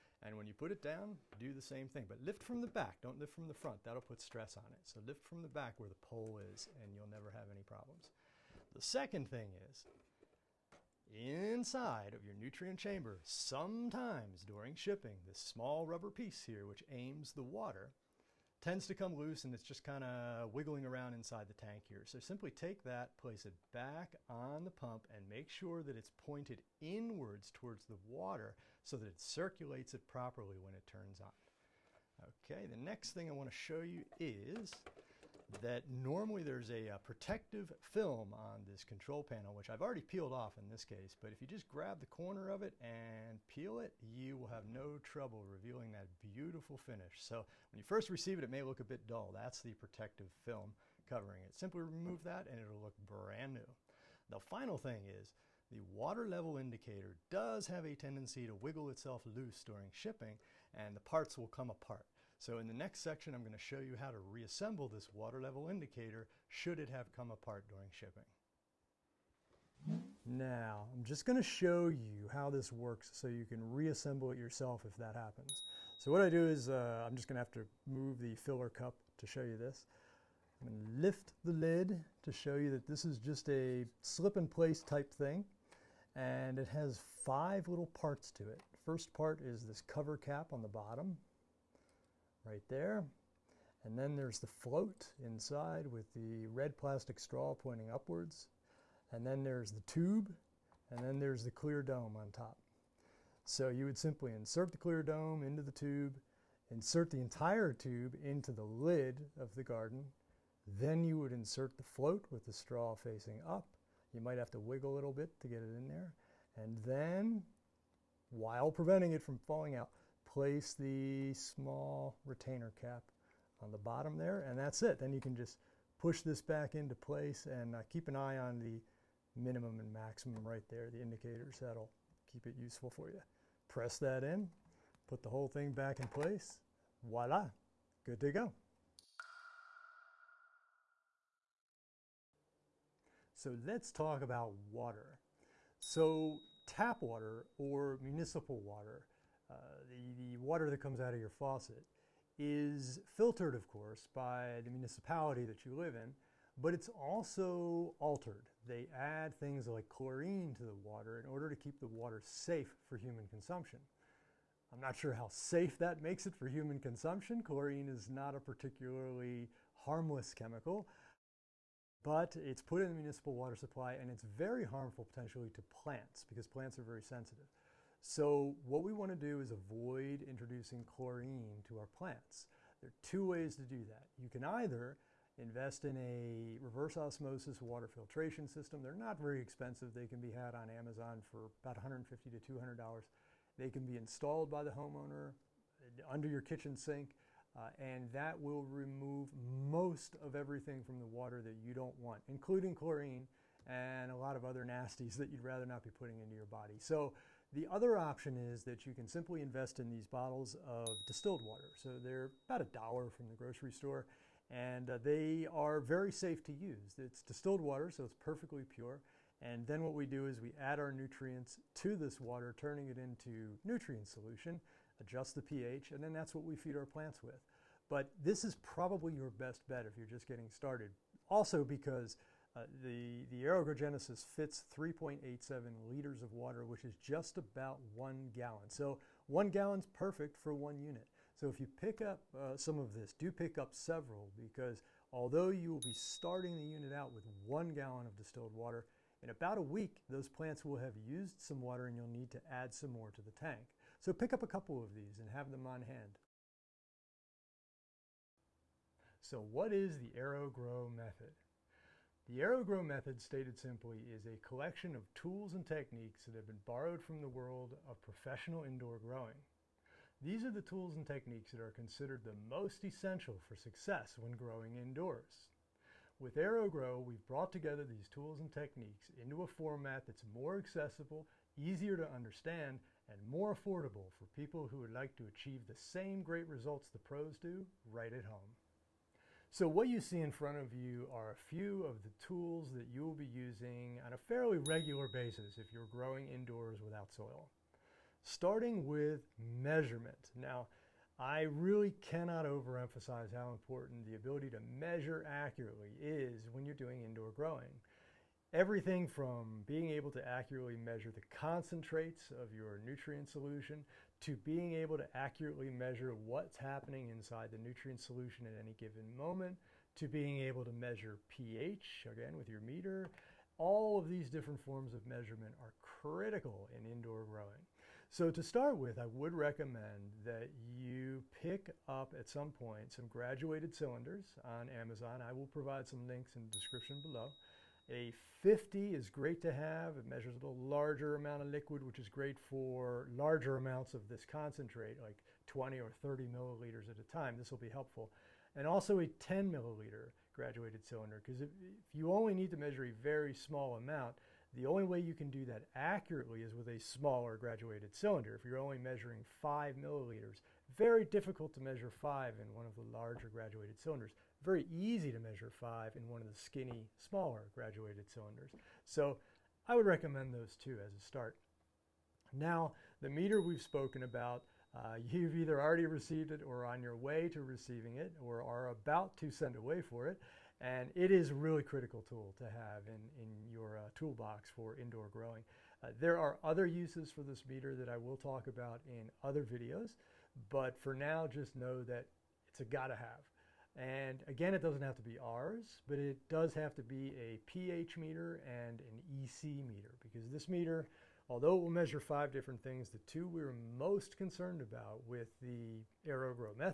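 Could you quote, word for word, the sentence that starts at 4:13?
So pick up a couple of these and have them on hand.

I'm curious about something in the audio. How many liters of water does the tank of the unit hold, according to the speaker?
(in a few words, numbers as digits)
3.87 liters.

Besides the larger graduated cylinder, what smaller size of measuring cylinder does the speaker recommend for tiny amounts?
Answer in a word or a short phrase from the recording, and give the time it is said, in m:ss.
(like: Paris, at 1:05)
10 milliliter, at 5:49.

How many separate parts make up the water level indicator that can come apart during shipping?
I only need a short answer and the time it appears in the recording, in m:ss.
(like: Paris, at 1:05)
5, at 1:26.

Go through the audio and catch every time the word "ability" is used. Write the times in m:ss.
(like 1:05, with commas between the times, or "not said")
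5:04.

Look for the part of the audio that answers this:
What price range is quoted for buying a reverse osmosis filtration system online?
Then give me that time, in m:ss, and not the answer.
3:11.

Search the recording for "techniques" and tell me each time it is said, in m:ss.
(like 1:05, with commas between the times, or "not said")
4:25, 4:31, 4:38.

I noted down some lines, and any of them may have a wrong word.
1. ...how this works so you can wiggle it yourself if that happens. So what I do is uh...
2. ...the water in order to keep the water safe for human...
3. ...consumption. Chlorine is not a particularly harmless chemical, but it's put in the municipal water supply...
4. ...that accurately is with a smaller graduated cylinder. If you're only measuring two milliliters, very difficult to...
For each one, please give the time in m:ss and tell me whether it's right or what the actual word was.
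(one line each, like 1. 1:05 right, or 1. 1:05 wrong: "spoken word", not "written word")
1. 1:12 wrong: "reassemble", not "wiggle"
2. 2:40 right
3. 2:46 right
4. 5:55 wrong: "five", not "two".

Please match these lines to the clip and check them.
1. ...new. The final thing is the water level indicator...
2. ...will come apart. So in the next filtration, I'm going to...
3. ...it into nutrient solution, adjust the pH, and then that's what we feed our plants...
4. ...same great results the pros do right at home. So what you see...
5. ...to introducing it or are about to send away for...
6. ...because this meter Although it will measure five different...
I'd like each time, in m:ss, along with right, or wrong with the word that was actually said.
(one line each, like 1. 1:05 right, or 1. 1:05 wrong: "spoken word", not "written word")
1. 0:53 right
2. 1:01 wrong: "section", not "filtration"
3. 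3:42 right
4. 4:45 right
5. 6:17 wrong: "receiving", not "introducing"
6. 6:39 right.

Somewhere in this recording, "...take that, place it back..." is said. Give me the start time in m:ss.
0:22.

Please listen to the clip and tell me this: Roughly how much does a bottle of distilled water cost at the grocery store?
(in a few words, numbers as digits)
About a dollar.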